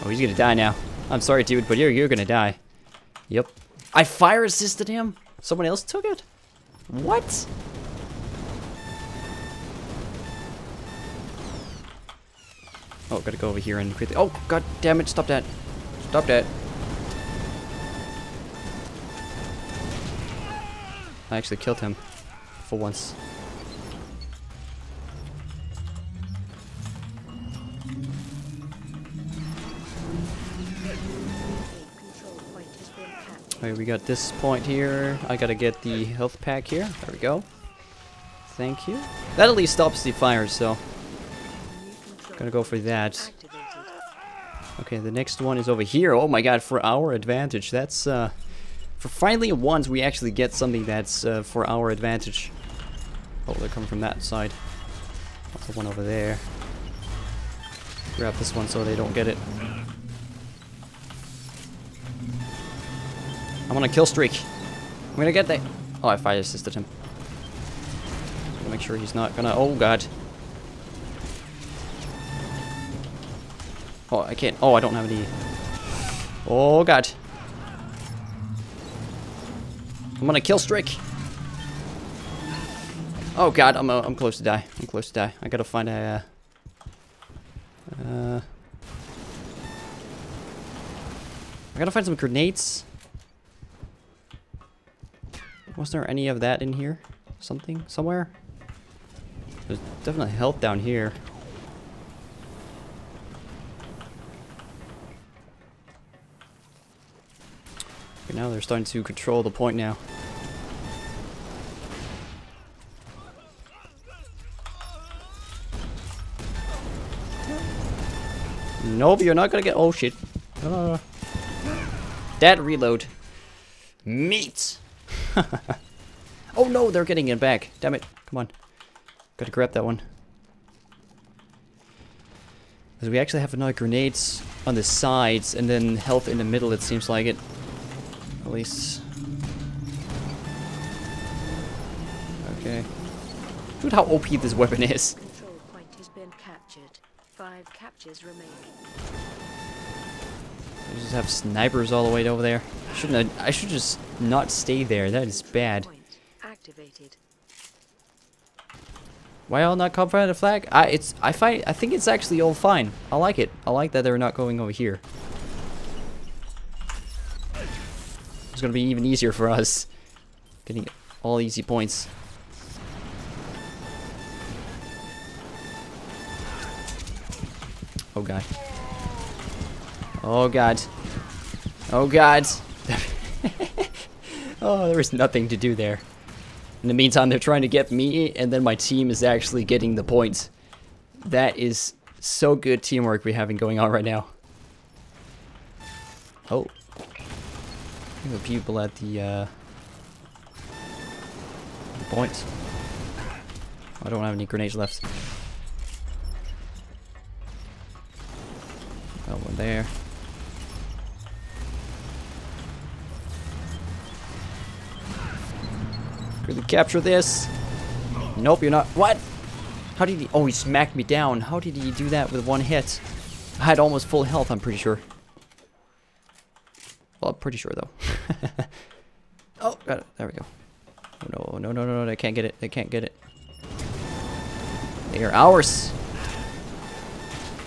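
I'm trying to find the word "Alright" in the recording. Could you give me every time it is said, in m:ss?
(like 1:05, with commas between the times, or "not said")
0:33.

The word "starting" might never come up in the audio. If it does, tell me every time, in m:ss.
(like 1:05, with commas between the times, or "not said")
1:48.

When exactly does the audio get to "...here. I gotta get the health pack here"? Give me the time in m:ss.
0:34.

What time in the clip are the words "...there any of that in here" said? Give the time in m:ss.
1:35.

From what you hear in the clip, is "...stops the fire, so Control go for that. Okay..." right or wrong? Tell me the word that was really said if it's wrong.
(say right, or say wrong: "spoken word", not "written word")
wrong: "Gonna", not "Control".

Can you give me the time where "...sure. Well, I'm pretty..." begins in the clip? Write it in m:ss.
3:44.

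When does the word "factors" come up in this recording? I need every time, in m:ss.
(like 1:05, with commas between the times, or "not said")
not said.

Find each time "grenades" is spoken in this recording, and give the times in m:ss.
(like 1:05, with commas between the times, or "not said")
1:32, 2:13, 3:24.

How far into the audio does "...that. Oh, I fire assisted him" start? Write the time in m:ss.
1:05.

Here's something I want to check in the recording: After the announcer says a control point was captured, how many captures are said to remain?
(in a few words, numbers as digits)
5.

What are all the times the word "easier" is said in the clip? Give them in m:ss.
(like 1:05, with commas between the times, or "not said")
2:49.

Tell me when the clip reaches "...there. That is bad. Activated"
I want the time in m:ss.
2:34.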